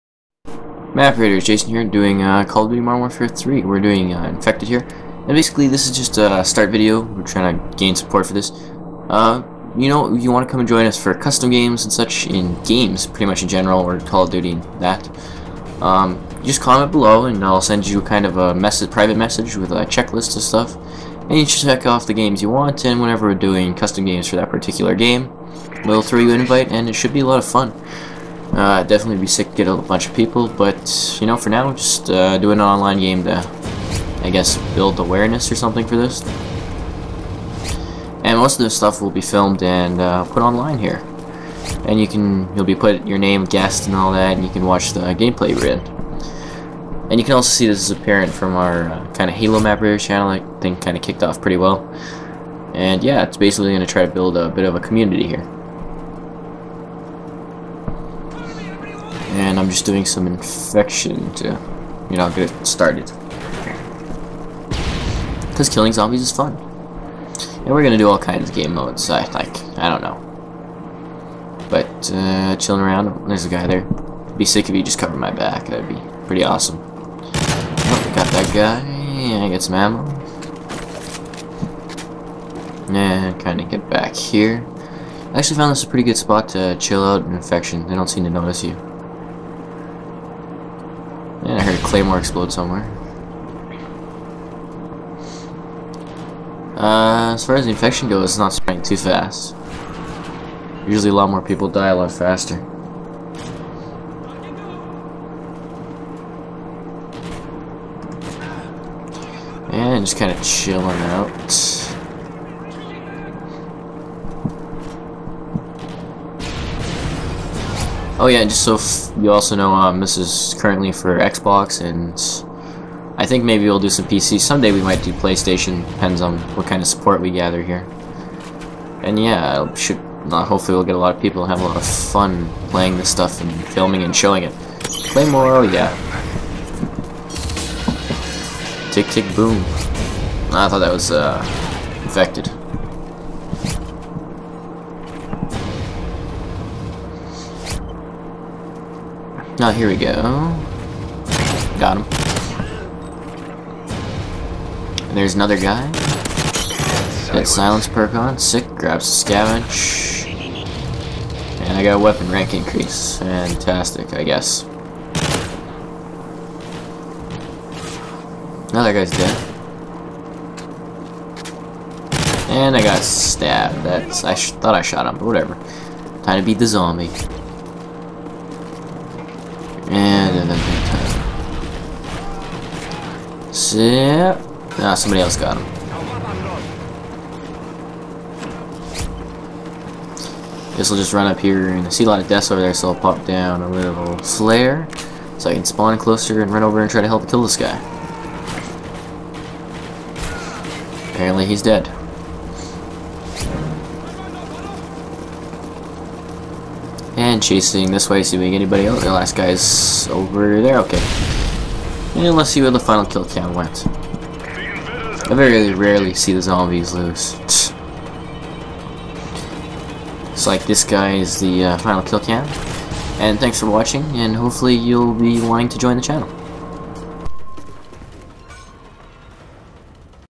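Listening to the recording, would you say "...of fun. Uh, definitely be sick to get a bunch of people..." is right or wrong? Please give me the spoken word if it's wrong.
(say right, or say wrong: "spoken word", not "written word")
right.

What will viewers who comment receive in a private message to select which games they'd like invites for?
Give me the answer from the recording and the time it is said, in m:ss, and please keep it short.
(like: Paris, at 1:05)
A checklist, at 0:19.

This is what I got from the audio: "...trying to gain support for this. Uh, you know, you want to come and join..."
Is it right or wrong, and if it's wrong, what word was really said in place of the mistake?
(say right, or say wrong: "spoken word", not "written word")
right.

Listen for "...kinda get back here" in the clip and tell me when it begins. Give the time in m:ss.
1:23.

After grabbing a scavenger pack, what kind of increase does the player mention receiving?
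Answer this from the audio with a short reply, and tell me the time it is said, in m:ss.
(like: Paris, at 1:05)
Weapon rank increase, at 2:41.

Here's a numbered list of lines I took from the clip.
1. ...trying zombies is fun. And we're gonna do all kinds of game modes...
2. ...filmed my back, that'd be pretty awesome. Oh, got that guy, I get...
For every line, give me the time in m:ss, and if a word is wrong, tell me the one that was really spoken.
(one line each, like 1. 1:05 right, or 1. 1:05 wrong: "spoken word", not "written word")
1. 1:05 wrong: "killing", not "trying"
2. 1:14 wrong: "covered", not "filmed".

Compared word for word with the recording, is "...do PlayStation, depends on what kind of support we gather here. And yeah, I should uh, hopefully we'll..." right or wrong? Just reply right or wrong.
right.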